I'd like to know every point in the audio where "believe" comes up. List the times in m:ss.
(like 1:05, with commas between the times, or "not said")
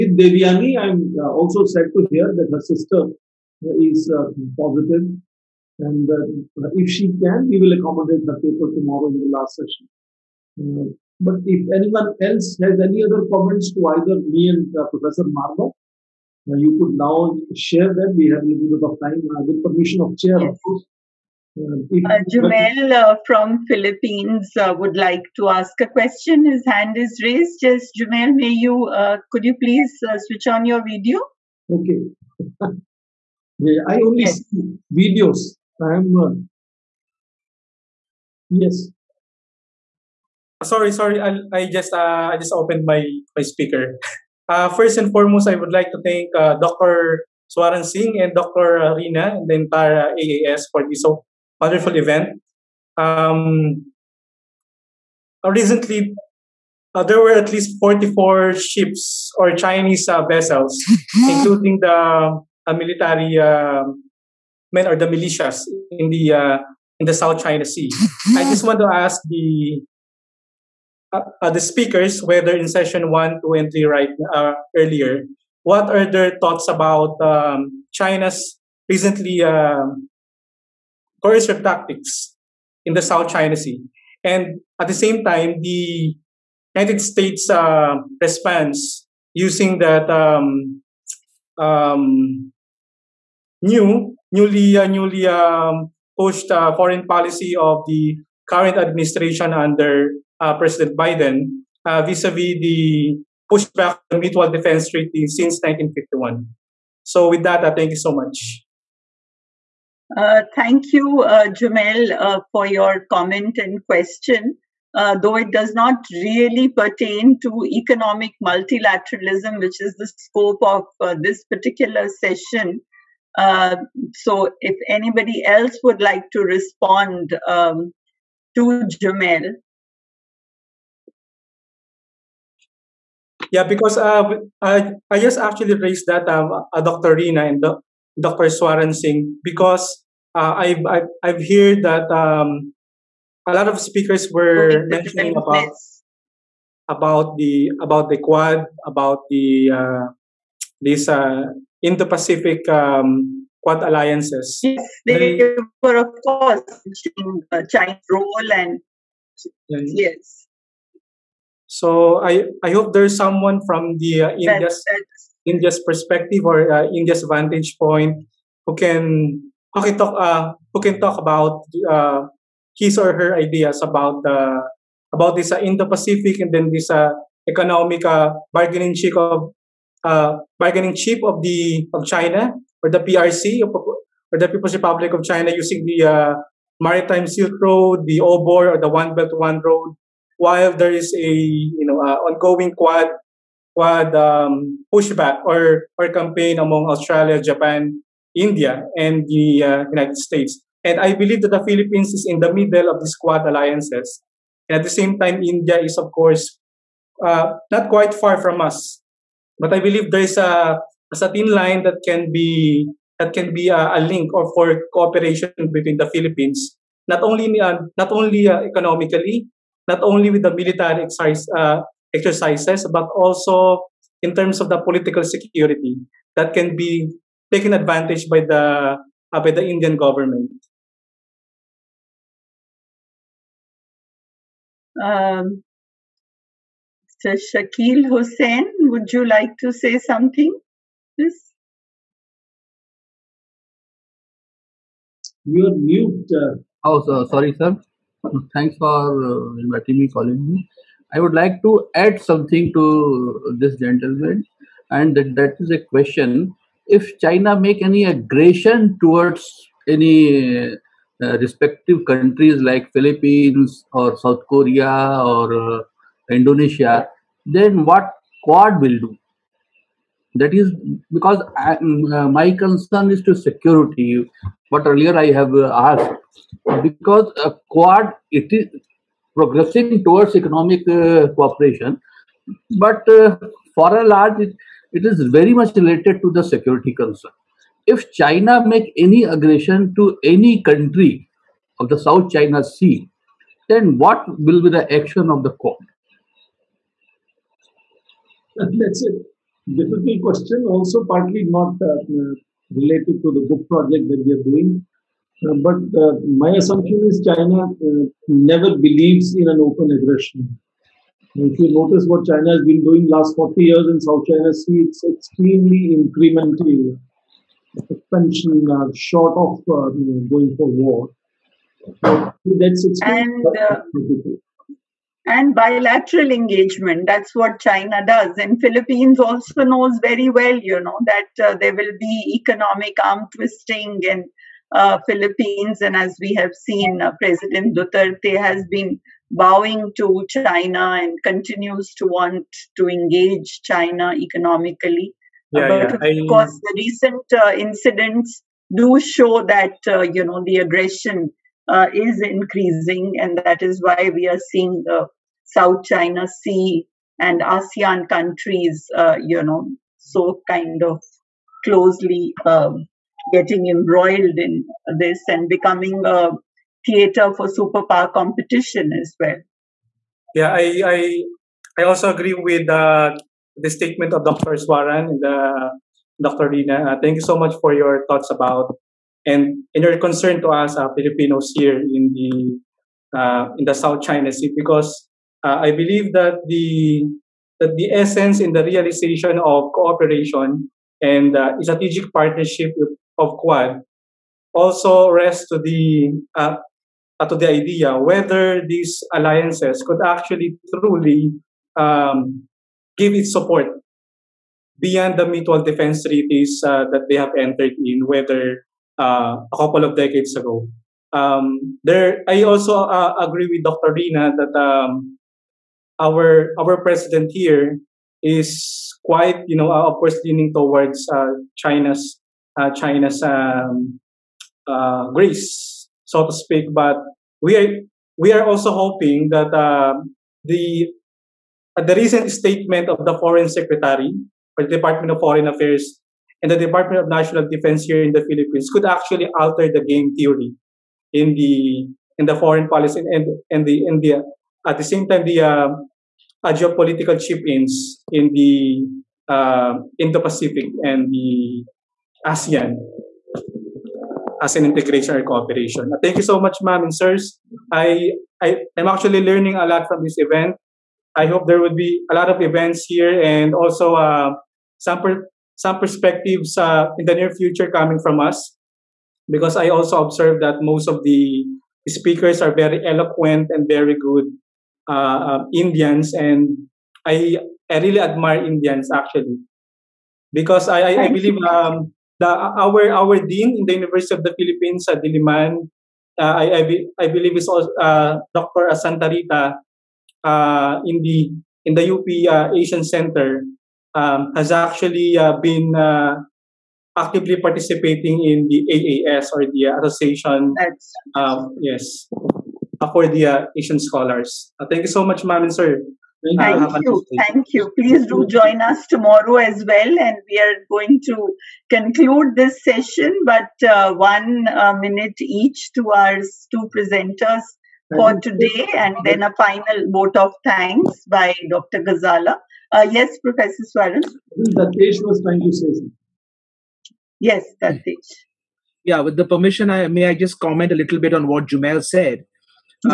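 3:21, 3:29, 5:08, 6:25, 8:01, 8:07.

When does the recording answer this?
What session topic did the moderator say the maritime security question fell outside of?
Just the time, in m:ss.
1:57.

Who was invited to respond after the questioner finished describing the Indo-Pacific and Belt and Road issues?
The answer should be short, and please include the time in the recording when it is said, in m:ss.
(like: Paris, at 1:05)
Shakil Hussain, at 3:57.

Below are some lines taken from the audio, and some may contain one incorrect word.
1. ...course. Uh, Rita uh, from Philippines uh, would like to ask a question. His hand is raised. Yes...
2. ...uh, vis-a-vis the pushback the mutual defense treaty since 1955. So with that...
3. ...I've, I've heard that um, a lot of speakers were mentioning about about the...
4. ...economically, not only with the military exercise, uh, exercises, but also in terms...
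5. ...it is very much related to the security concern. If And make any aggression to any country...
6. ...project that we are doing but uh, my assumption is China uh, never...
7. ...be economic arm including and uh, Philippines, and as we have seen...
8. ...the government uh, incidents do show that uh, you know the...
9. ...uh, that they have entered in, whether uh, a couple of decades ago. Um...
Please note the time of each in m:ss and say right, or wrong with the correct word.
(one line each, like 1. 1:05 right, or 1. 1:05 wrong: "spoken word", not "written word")
1. 0:20 wrong: "Jumel", not "Rita"
2. 1:41 wrong: "1951", not "1955"
3. 2:20 right
4. 3:38 right
5. 4:44 wrong: "China", not "And"
6. 5:03 right
7. 5:31 wrong: "twisting", not "including"
8. 5:46 wrong: "recent", not "government"
9. 6:46 right.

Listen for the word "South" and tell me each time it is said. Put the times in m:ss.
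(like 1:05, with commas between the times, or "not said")
1:07, 1:23, 4:24, 4:51, 5:14, 5:55, 6:23.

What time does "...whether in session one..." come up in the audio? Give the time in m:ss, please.
1:12.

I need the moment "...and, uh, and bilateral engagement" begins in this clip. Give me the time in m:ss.
5:23.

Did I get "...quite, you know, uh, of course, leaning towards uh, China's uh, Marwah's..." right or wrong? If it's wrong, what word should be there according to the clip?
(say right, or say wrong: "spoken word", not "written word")
wrong: "China", not "Marwah".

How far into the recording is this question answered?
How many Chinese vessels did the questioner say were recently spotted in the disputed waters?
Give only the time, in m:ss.
0:57.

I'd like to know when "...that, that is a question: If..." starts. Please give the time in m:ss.
4:15.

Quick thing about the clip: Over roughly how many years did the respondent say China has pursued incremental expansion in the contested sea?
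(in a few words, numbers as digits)
40 years.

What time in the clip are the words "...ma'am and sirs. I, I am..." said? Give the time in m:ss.
7:36.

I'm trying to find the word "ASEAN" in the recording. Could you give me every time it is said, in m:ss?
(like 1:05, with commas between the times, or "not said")
5:57, 7:32.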